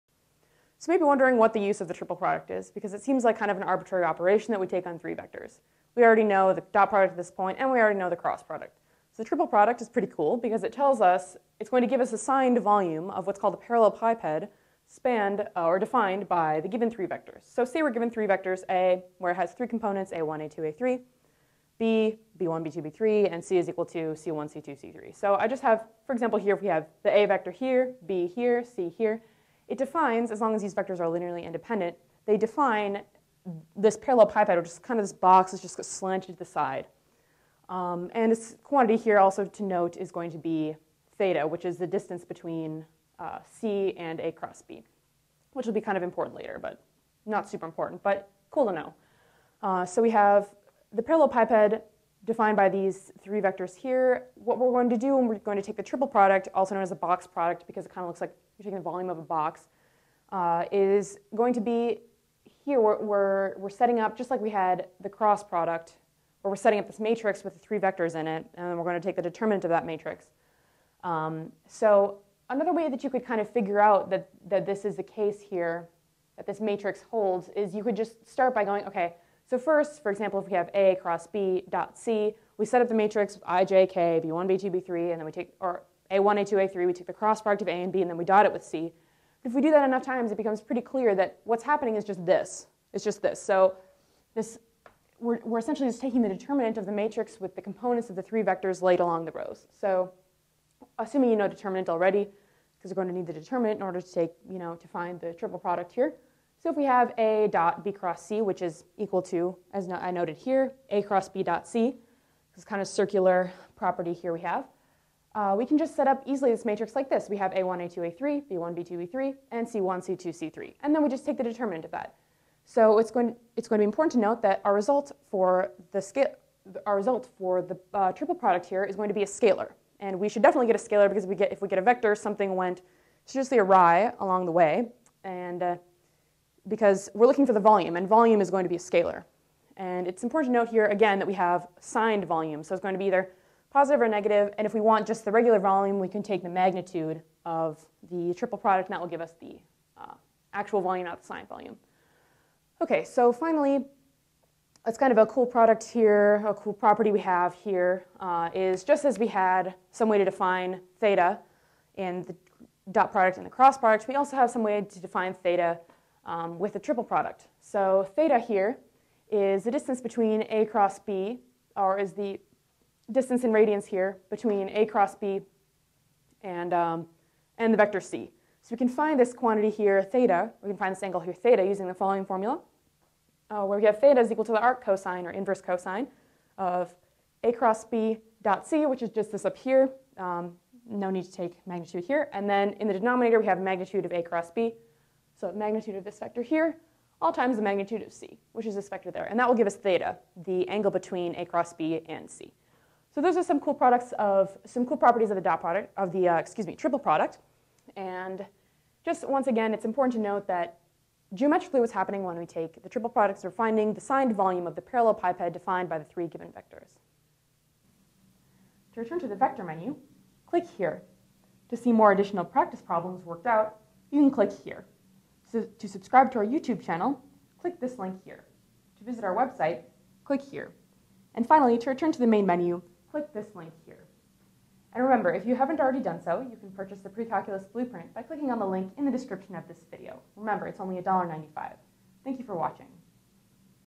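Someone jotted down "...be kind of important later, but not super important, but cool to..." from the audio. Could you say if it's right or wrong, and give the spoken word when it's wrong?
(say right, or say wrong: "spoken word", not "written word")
right.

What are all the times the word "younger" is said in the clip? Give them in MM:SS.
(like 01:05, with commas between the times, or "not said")
not said.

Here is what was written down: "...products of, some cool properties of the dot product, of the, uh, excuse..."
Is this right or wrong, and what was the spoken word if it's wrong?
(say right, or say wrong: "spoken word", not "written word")
right.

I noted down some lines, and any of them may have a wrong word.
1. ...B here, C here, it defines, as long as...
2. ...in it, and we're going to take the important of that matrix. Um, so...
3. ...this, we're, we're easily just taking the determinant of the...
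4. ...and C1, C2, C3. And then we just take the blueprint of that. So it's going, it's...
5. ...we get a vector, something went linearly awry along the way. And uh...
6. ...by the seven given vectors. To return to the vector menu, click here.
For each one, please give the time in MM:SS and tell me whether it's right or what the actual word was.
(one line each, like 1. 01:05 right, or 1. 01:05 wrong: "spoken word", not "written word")
1. 00:28 right
2. 01:08 wrong: "determinant", not "important"
3. 01:34 wrong: "essentially", not "easily"
4. 01:59 wrong: "determinant", not "blueprint"
5. 02:11 wrong: "seriously", not "linearly"
6. 03:35 wrong: "three", not "seven".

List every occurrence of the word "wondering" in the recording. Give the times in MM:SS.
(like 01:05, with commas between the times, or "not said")
00:01.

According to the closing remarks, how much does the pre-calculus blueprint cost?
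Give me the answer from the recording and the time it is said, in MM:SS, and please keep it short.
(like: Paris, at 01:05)
$1.95, at 04:01.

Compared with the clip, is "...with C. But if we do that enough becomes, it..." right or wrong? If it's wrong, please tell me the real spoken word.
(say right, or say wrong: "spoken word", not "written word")
wrong: "times", not "becomes".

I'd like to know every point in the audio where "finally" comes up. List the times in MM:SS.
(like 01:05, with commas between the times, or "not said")
02:33, 03:51.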